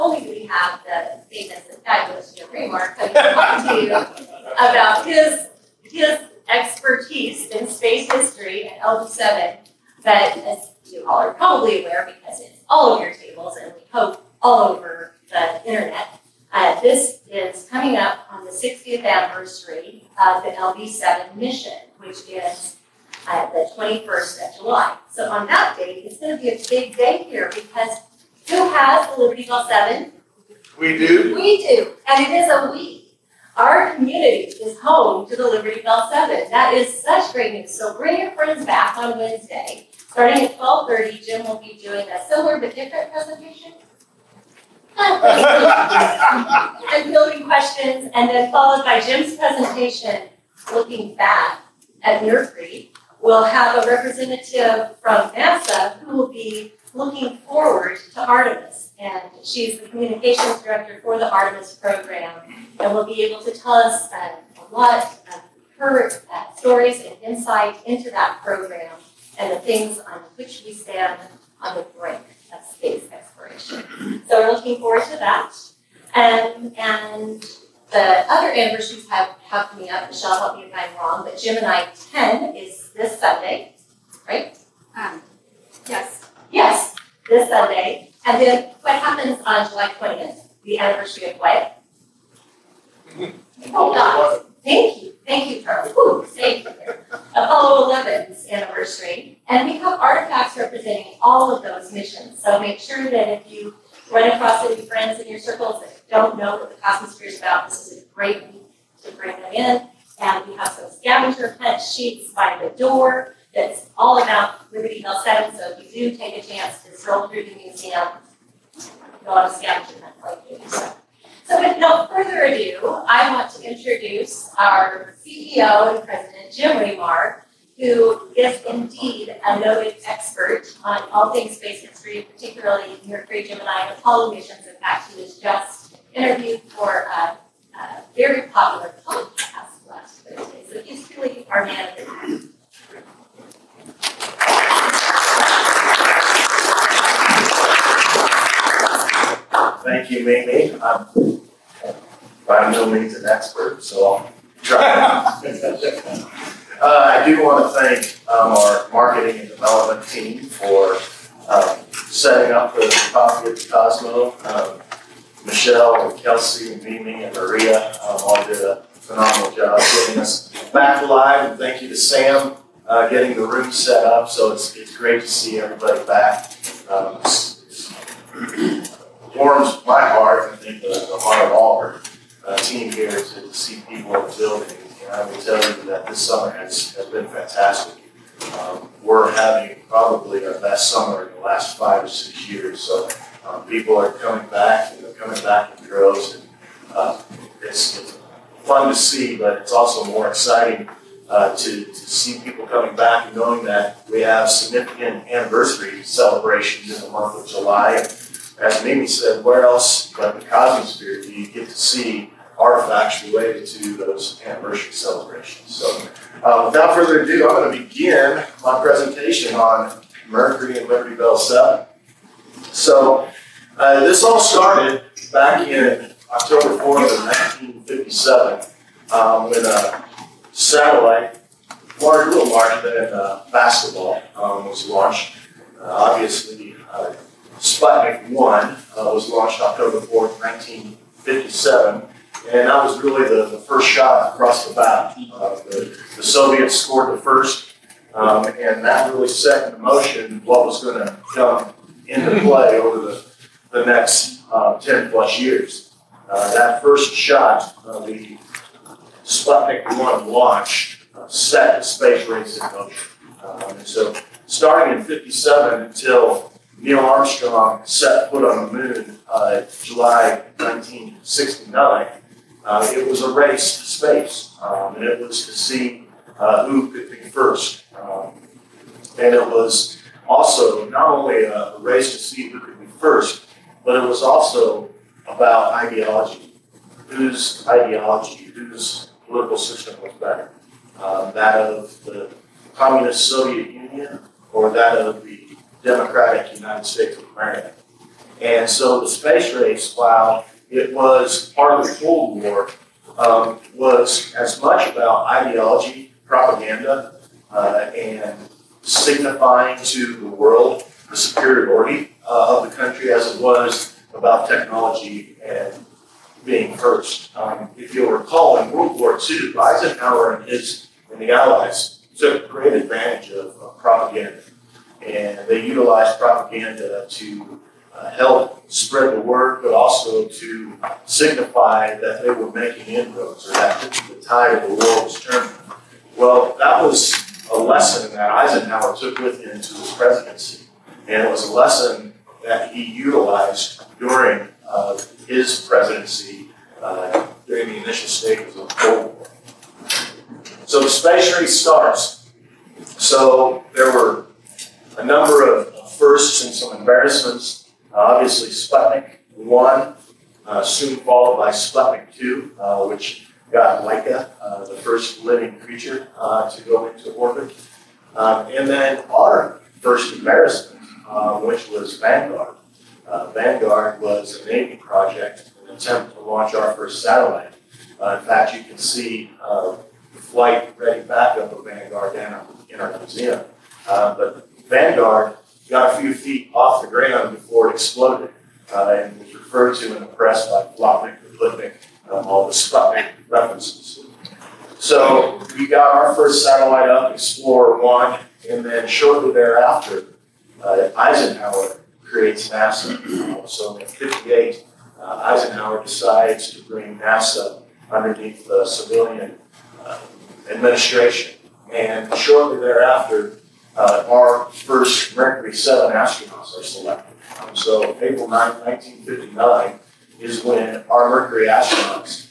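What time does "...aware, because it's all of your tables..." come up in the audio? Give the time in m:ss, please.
0:11.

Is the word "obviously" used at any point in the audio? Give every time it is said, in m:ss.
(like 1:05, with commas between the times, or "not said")
3:55, 5:57.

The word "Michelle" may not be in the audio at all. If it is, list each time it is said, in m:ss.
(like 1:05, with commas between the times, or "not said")
1:20, 2:45.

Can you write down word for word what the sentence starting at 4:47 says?
Whose ideology, whose political system was better?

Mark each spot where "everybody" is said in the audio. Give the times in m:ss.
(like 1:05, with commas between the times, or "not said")
2:55.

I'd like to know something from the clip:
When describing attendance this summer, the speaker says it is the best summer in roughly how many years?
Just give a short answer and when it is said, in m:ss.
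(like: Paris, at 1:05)
5 or 6, at 3:11.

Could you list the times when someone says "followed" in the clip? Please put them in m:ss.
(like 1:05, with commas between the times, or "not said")
0:48, 6:00.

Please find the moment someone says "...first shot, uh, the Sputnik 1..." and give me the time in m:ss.
4:16.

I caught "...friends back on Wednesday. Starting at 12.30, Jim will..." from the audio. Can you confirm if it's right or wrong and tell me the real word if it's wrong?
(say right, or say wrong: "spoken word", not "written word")
right.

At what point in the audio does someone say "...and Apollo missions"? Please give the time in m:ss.
2:13.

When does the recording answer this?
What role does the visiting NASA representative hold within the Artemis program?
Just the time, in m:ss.
0:59.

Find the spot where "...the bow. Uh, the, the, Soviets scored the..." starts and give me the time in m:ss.
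4:04.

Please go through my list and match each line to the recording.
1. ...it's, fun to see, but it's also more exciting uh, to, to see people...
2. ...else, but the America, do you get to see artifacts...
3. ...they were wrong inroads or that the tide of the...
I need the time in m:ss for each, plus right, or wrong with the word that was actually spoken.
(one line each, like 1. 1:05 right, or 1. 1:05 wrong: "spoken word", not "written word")
1. 3:17 right
2. 3:29 wrong: "Cosmosphere", not "America"
3. 5:32 wrong: "making", not "wrong".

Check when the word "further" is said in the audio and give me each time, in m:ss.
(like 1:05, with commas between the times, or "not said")
2:02, 3:36.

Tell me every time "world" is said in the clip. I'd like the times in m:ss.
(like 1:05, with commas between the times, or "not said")
5:10, 5:18.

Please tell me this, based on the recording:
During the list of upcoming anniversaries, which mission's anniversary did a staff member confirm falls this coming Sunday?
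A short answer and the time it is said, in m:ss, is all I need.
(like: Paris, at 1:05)
Gemini 10, at 1:21.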